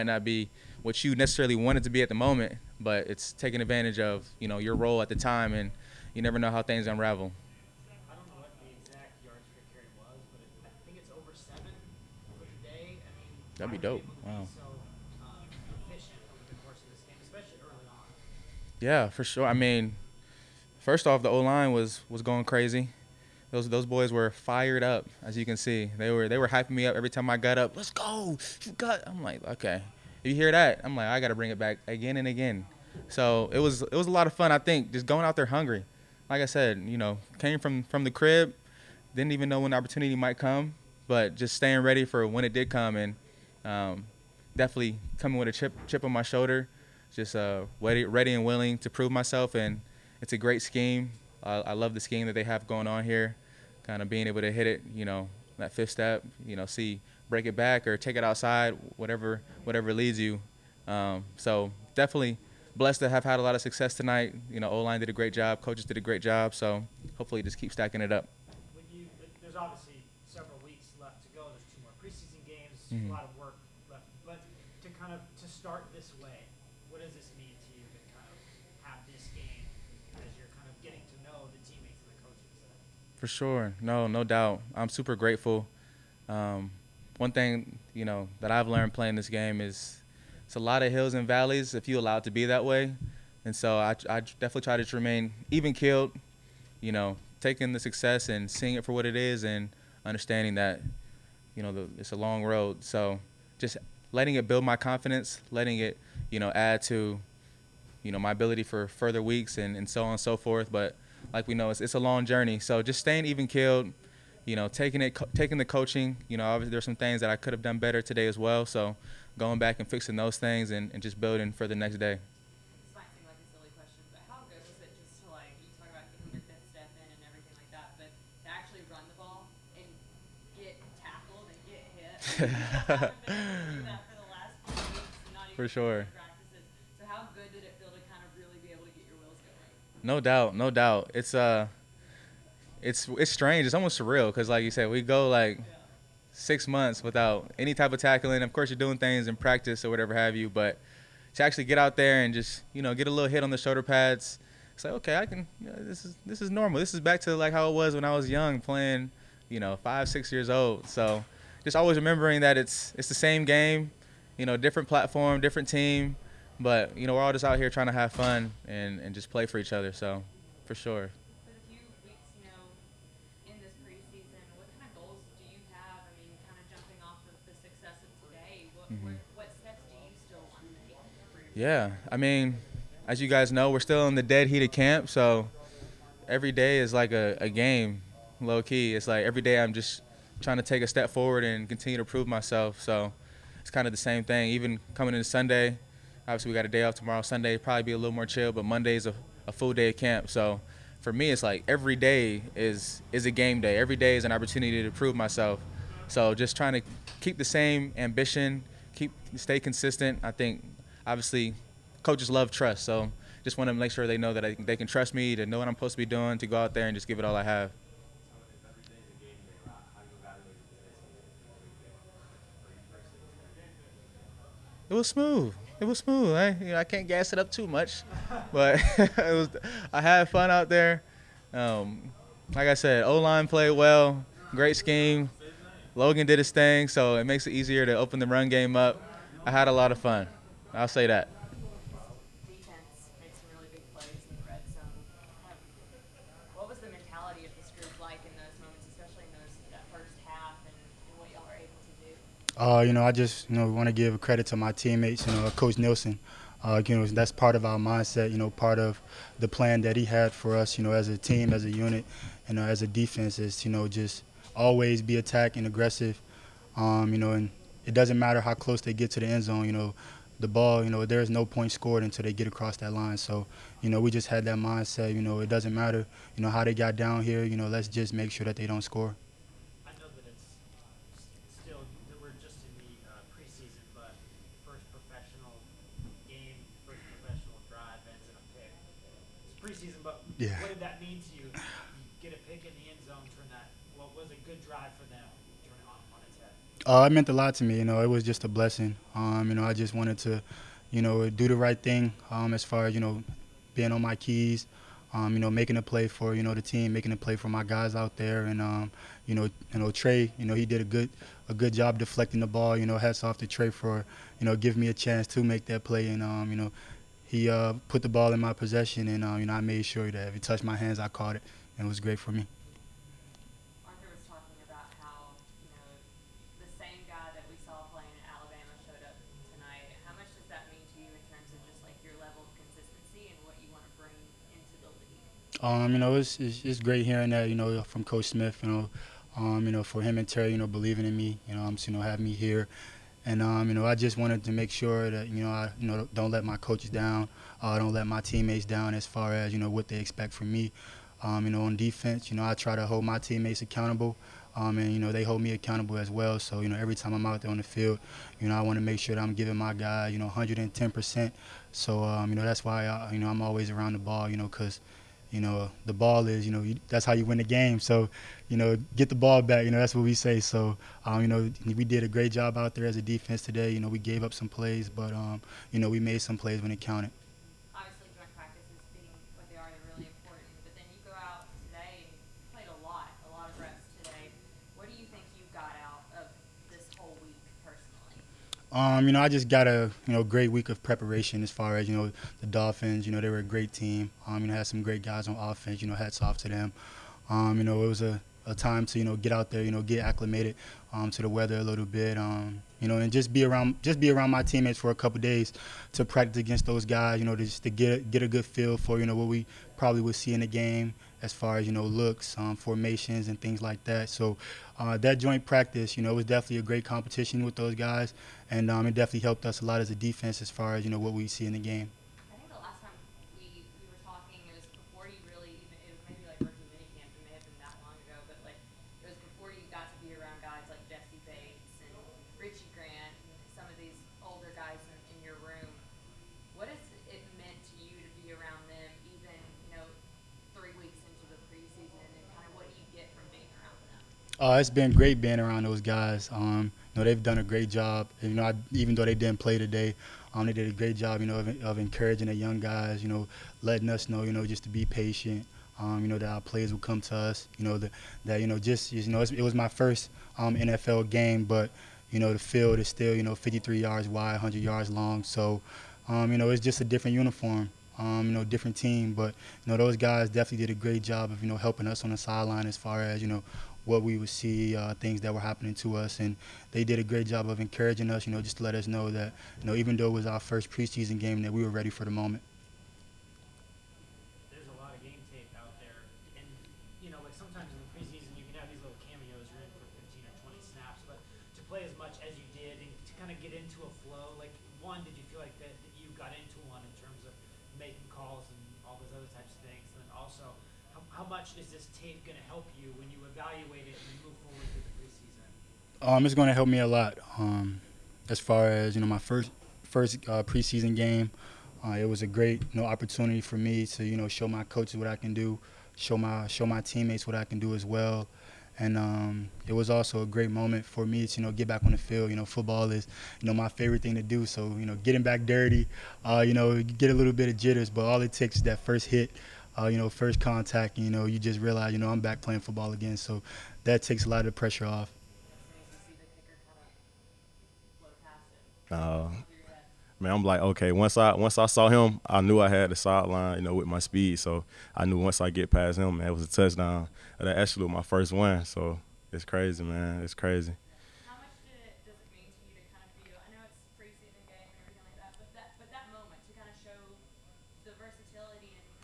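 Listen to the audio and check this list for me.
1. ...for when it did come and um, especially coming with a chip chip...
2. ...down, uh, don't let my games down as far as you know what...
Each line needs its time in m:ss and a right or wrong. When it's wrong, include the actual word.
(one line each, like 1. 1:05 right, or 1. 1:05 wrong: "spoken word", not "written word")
1. 0:42 wrong: "definitely", not "especially"
2. 5:46 wrong: "teammates", not "games".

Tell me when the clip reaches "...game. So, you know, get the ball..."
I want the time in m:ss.
6:07.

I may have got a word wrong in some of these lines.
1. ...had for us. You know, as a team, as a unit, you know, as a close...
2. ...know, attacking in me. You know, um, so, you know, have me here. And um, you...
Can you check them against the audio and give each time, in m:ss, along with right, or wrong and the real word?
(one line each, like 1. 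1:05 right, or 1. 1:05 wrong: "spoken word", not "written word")
1. 4:20 wrong: "defense", not "close"
2. 5:40 wrong: "believing", not "attacking".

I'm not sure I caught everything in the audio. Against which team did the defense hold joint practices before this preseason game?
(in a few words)
Dolphins.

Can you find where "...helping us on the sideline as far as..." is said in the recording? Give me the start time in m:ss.
7:51.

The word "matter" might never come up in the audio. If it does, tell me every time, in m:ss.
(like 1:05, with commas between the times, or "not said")
4:28, 4:35.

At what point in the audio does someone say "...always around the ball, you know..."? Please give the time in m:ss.
6:03.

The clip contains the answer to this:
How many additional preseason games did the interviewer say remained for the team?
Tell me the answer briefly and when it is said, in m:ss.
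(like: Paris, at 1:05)
2, at 1:11.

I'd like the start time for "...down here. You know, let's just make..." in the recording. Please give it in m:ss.
4:36.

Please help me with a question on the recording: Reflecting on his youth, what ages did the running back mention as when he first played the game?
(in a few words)
5 or 6.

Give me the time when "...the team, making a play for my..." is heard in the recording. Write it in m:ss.
5:06.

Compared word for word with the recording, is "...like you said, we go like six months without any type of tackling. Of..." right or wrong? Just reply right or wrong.
right.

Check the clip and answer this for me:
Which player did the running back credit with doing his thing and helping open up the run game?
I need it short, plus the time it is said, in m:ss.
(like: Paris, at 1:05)
Logan, at 3:55.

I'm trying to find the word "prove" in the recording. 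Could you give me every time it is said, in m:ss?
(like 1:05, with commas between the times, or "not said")
0:48, 3:12, 3:24.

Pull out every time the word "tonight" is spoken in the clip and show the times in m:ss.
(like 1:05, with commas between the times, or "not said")
1:03, 5:29.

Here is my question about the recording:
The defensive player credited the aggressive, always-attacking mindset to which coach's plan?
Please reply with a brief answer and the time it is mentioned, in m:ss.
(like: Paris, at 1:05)
Coach Nielsen, at 4:15.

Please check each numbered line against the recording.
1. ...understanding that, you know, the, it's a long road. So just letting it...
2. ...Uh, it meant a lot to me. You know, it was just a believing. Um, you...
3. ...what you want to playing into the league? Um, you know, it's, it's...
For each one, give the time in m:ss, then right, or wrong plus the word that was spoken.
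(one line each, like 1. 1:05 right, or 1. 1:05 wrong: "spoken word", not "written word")
1. 1:40 right
2. 4:57 wrong: "blessing", not "believing"
3. 5:33 wrong: "bring", not "playing".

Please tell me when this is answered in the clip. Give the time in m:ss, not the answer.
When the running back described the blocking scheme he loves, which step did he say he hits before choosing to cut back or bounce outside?
0:55.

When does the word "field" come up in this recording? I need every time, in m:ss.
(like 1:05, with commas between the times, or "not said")
5:57, 7:42, 8:41.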